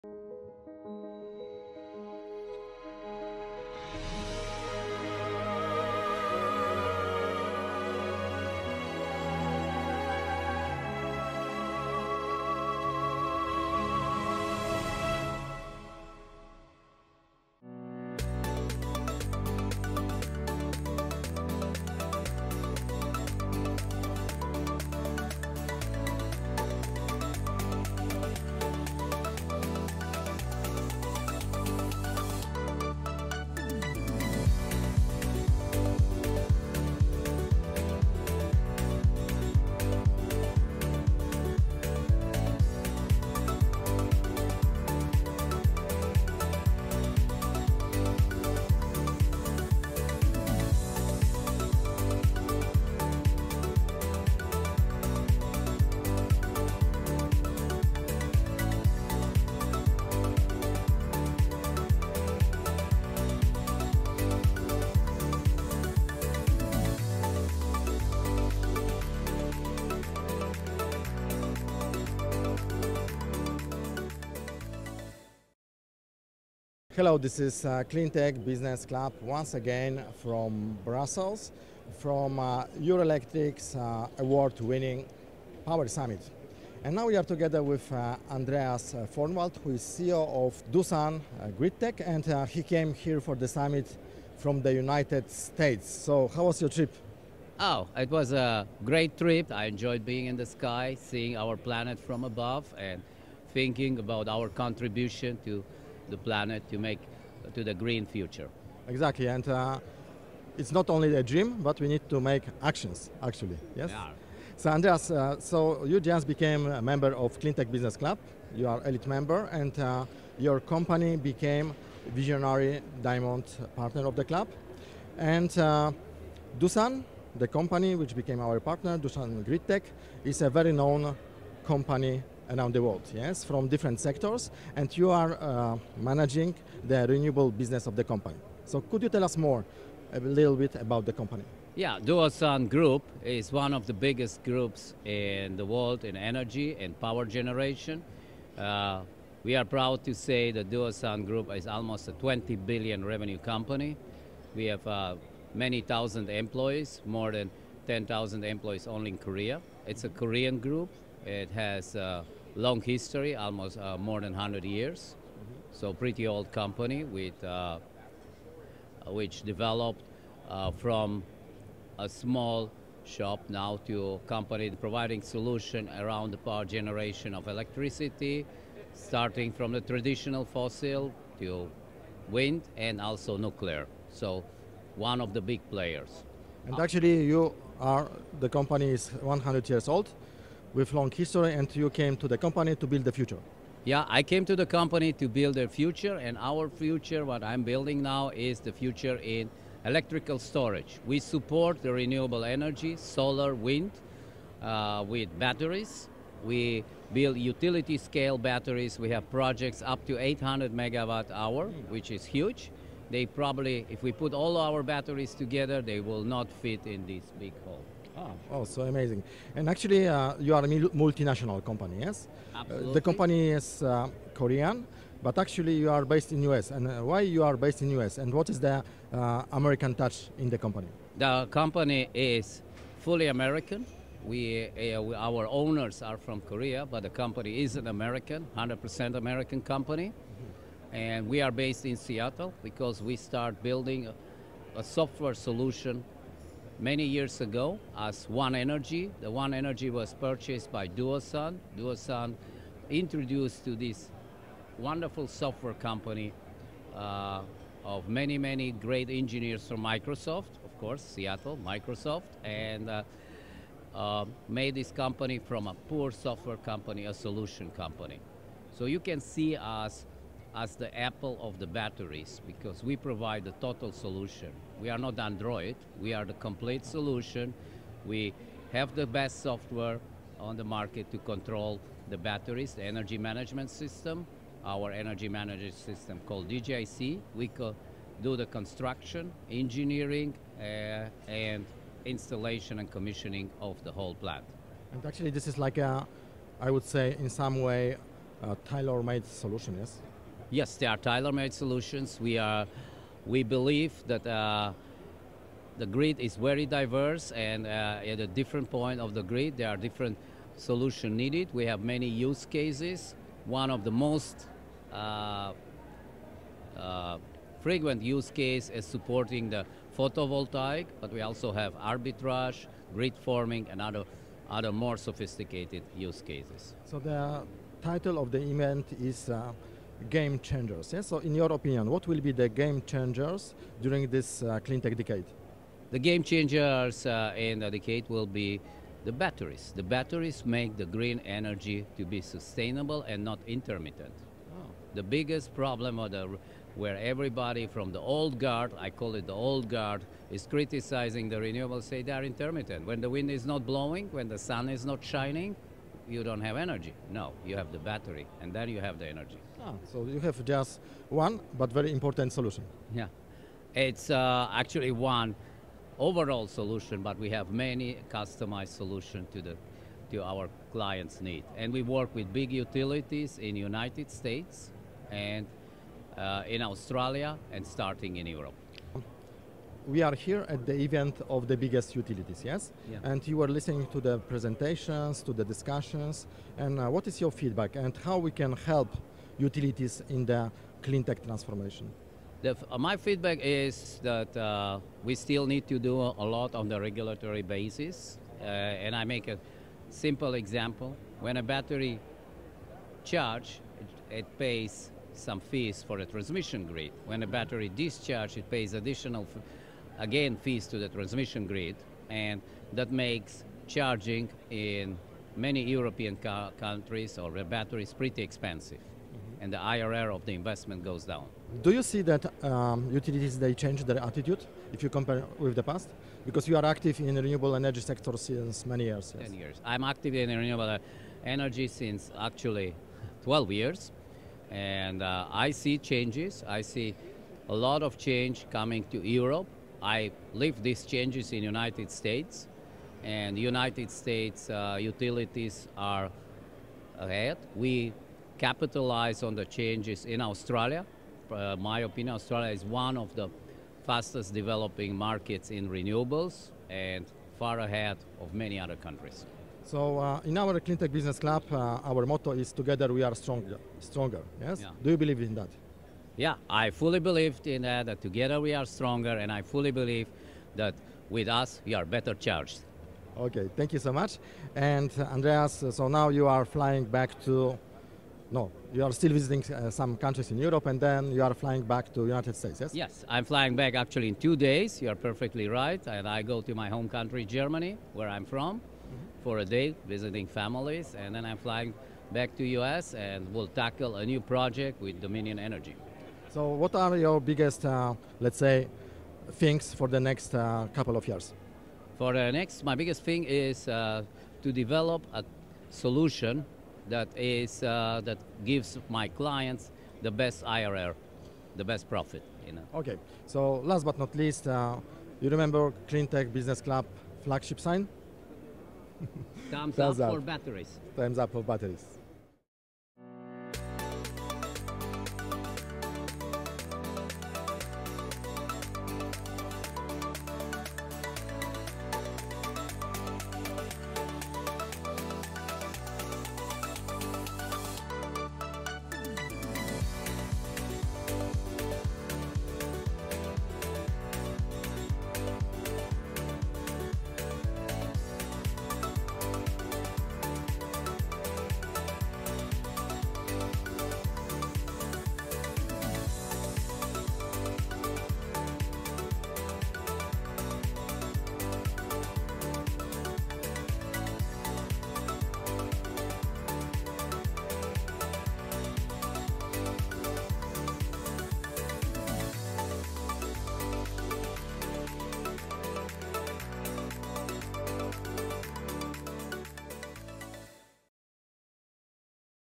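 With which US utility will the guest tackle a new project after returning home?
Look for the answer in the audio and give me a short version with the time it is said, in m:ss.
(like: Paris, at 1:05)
Dominion Energy, at 8:15.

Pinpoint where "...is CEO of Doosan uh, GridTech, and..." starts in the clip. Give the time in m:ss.
1:29.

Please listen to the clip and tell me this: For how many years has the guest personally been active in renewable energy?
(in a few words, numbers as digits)
12 years.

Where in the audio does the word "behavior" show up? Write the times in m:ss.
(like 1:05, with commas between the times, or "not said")
not said.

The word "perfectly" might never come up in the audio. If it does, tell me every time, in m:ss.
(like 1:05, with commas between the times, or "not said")
8:04.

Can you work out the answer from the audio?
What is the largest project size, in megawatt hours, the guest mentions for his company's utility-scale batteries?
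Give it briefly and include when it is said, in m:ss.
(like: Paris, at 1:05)
800 megawatt hour, at 3:30.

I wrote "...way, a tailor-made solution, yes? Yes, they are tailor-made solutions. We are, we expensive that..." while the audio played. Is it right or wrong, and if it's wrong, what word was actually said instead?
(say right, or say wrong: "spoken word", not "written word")
wrong: "believe", not "expensive".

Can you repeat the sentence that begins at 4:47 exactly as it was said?
We co do the construction, engineering, uh, and installation and commissioning of the whole plant.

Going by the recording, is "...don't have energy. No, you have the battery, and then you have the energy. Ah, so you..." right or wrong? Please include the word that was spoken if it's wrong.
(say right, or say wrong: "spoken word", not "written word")
right.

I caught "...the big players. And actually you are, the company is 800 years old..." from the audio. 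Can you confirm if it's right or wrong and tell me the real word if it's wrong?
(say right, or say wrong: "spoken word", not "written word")
wrong: "100", not "800".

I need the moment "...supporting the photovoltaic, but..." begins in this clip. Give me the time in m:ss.
5:18.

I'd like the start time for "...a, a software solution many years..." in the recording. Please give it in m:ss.
4:04.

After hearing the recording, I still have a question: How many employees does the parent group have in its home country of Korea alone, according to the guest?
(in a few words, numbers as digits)
more than 10,000.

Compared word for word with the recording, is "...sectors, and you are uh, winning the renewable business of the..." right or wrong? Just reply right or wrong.
wrong.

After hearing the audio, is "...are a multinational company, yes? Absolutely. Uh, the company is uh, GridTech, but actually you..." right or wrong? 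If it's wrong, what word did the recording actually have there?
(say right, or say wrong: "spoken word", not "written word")
wrong: "Korean", not "GridTech".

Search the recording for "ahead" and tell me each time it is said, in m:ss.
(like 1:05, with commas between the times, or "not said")
7:26, 7:37.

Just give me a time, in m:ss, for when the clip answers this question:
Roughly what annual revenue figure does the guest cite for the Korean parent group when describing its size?
2:32.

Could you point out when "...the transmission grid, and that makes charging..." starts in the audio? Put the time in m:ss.
6:50.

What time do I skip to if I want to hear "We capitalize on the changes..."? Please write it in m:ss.
7:27.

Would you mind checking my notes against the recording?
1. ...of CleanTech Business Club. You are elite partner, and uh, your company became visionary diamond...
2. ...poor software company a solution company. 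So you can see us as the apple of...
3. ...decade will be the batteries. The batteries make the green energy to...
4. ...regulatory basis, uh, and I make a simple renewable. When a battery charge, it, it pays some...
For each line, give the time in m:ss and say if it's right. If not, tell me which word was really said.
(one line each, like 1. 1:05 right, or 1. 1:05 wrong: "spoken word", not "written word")
1. 1:57 wrong: "member", not "partner"
2. 4:25 right
3. 5:37 right
4. 6:36 wrong: "example", not "renewable".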